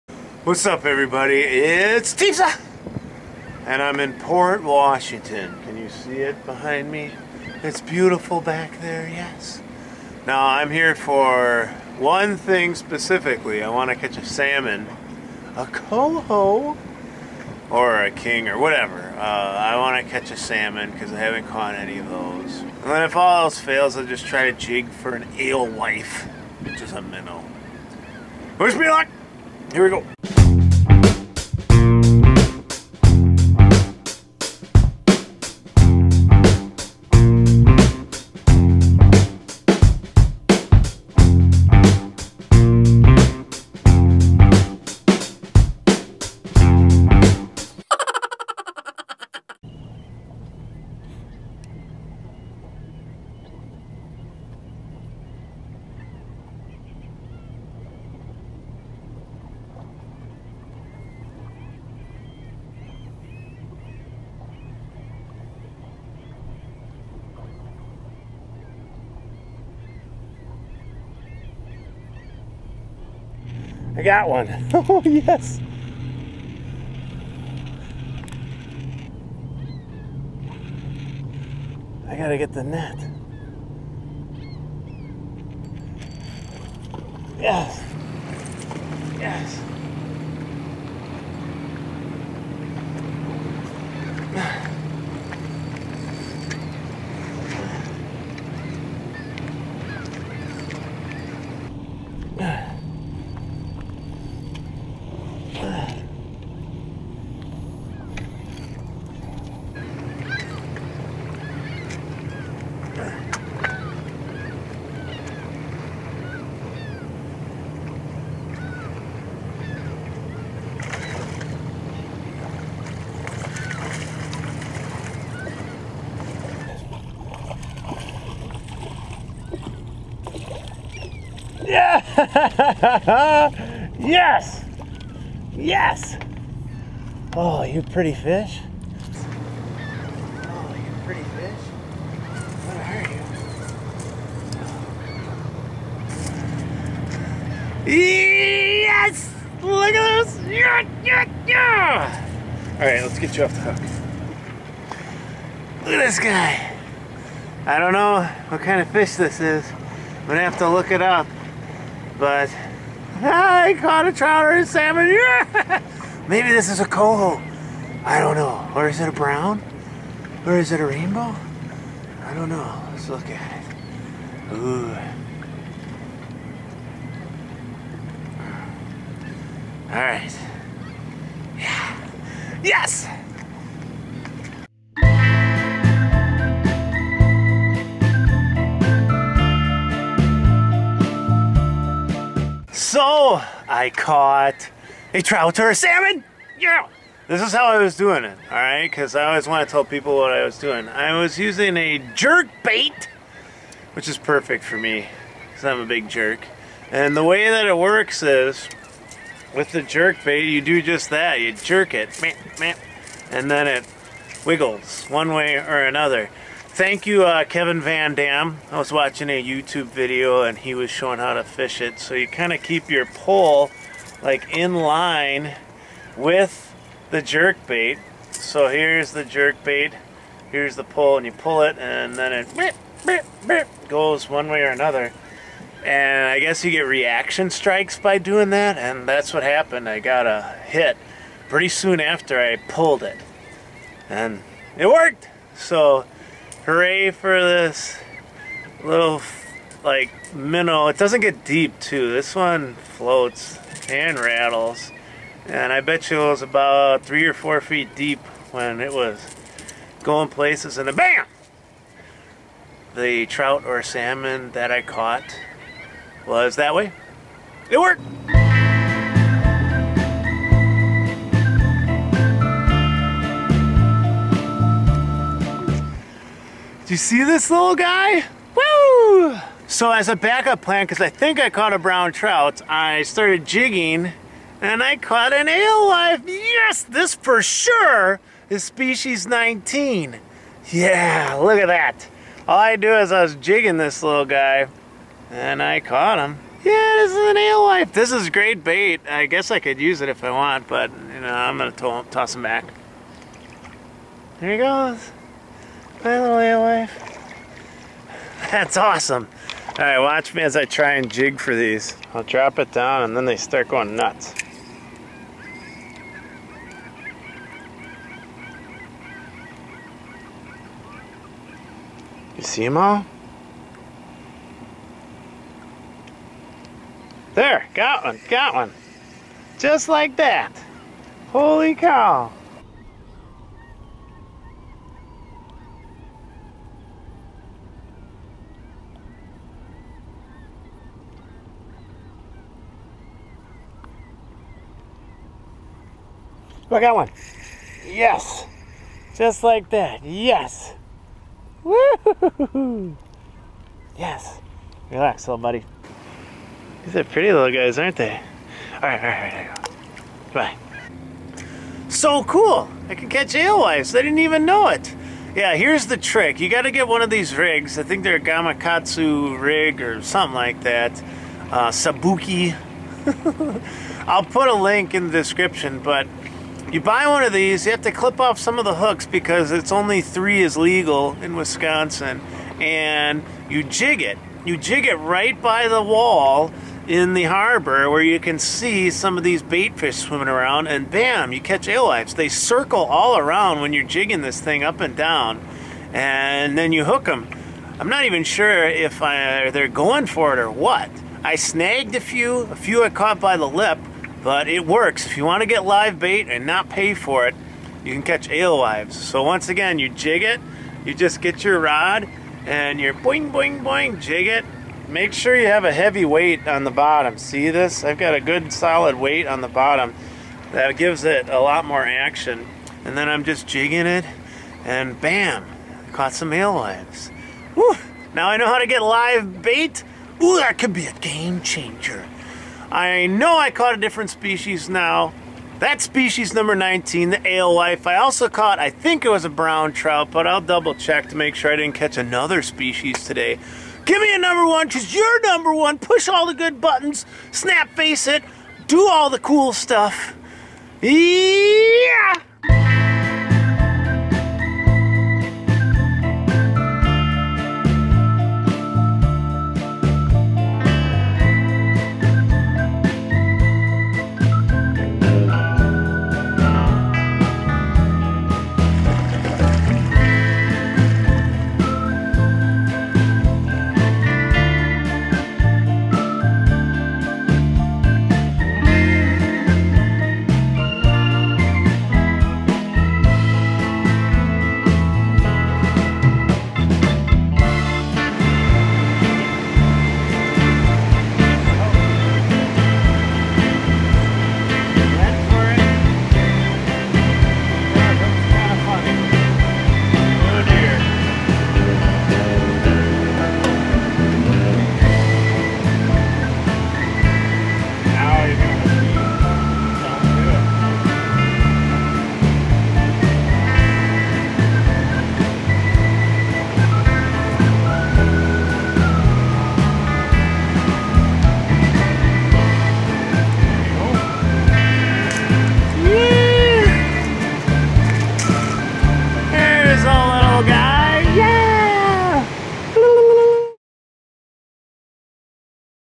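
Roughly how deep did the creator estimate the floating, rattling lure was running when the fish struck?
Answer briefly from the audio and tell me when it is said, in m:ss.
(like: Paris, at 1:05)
3 or 4 feet, at 4:17.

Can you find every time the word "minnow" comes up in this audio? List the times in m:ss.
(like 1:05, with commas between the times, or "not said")
0:27, 4:10.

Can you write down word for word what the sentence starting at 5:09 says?
All right, watch me as I try and jig for these.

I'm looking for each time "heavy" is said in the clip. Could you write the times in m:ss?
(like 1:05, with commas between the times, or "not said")
6:55.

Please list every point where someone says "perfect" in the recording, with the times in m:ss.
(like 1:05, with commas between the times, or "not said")
3:24.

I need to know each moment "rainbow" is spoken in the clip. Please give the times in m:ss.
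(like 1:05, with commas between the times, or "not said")
2:50.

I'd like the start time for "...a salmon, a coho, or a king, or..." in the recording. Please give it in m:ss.
0:14.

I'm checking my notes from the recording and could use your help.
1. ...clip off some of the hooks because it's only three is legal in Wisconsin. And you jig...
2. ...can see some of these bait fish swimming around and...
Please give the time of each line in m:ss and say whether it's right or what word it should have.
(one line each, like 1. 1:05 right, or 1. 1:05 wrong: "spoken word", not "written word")
1. 6:17 right
2. 6:28 right.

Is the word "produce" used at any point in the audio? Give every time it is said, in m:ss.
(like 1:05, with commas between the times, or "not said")
not said.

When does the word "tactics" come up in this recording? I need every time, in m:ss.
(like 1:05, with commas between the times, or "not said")
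not said.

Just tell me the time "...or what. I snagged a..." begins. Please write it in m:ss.
6:40.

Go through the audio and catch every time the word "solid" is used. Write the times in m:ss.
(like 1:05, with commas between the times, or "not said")
6:58.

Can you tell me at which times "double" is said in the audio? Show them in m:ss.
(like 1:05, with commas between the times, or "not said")
7:20.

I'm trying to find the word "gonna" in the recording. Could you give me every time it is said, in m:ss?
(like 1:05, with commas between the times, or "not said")
2:40, 5:01.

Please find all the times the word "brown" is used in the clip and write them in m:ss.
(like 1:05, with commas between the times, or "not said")
2:49, 4:41, 7:19.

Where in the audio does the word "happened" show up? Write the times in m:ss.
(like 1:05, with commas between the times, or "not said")
3:59.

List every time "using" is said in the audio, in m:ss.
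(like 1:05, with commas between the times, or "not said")
3:21.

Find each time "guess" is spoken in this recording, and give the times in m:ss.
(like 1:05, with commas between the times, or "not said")
3:56, 4:59.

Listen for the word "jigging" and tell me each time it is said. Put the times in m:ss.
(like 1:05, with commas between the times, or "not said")
4:43, 4:53, 6:33, 7:03.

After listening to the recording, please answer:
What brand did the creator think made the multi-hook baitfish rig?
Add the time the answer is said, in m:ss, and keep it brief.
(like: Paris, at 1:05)
Gamakatsu, at 6:08.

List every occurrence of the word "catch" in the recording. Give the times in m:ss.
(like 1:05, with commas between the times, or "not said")
0:13, 0:20, 6:03, 6:31, 6:48, 7:21.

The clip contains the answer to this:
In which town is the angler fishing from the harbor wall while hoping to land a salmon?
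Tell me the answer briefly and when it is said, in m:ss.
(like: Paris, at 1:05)
Port Washington, at 0:04.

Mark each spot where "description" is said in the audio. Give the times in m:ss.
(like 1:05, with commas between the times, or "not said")
6:15.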